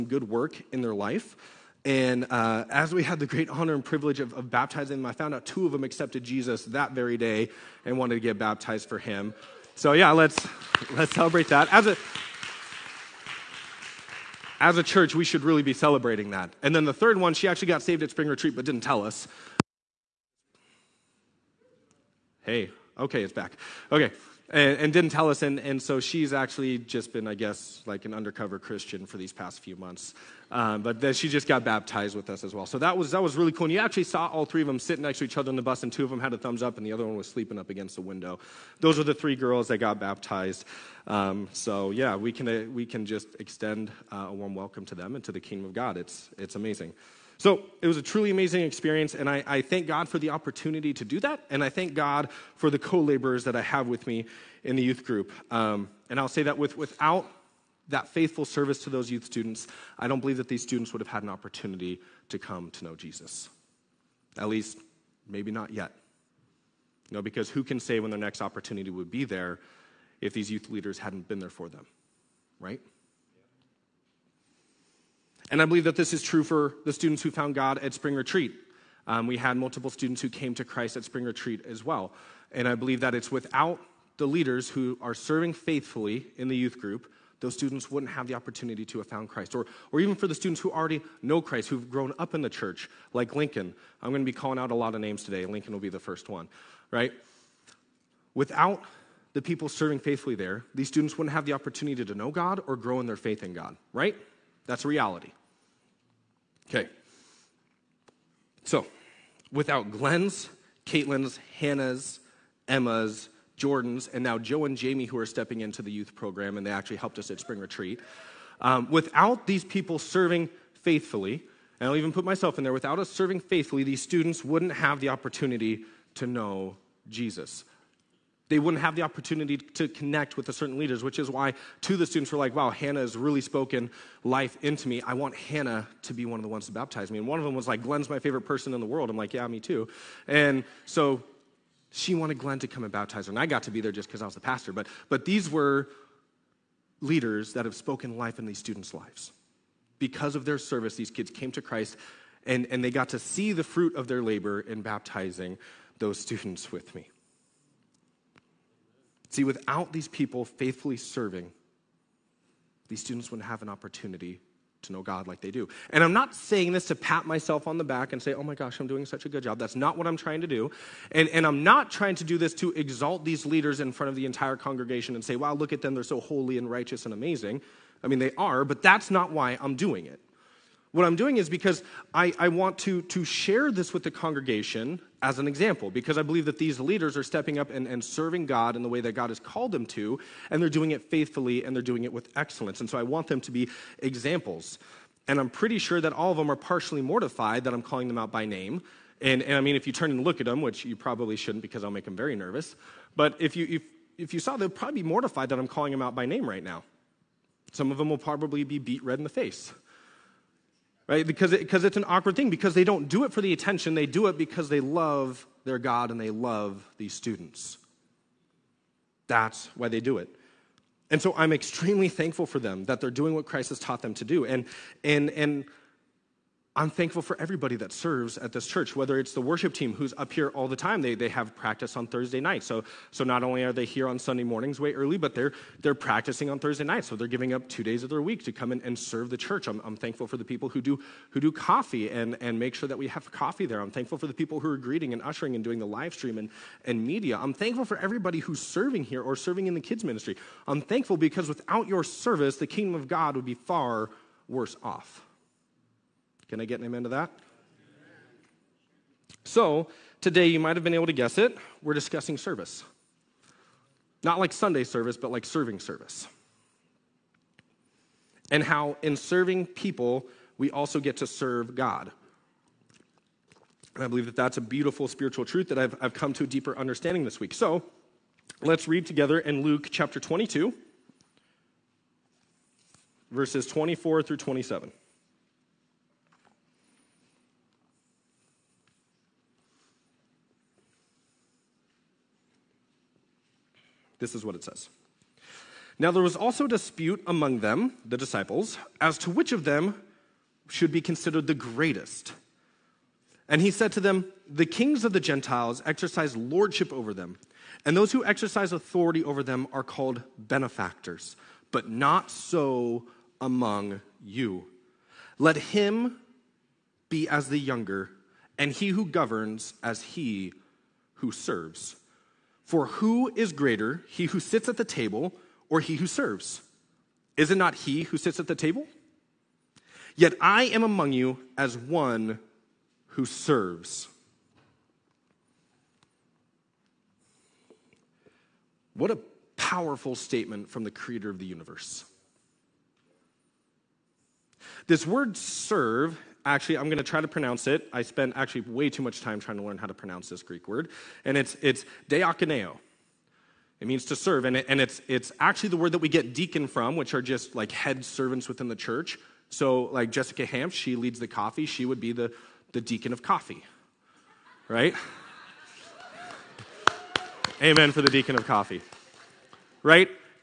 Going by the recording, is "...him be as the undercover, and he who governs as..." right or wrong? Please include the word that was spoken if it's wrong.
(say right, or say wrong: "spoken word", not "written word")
wrong: "younger", not "undercover".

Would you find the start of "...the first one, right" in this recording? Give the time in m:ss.
1:35.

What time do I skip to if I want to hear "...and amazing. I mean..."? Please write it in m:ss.
2:57.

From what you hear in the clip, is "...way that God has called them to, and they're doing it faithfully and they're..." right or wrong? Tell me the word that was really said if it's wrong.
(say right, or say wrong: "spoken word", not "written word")
right.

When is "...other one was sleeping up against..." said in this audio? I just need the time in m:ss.
0:36.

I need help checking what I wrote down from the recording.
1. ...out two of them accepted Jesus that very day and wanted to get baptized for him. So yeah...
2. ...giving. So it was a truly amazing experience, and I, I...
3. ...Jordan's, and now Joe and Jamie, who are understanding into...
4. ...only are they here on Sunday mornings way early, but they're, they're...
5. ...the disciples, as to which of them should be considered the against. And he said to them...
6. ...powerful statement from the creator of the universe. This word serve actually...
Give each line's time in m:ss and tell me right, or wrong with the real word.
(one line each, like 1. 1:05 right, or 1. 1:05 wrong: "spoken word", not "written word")
1. 0:05 right
2. 0:46 wrong: "amazing", not "giving"
3. 1:53 wrong: "stepping", not "understanding"
4. 3:53 right
5. 4:58 wrong: "greatest", not "against"
6. 5:39 right.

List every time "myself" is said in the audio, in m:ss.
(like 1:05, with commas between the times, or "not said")
2:02, 2:47.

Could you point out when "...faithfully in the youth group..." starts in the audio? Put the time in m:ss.
1:25.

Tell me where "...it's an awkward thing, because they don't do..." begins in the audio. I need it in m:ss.
3:31.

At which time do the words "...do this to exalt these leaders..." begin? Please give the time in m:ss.
2:52.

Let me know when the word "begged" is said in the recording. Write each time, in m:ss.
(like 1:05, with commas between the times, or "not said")
not said.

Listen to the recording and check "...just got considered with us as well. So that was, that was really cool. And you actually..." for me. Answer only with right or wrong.
wrong.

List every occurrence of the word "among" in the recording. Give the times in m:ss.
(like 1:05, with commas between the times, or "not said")
4:57, 5:13, 5:30.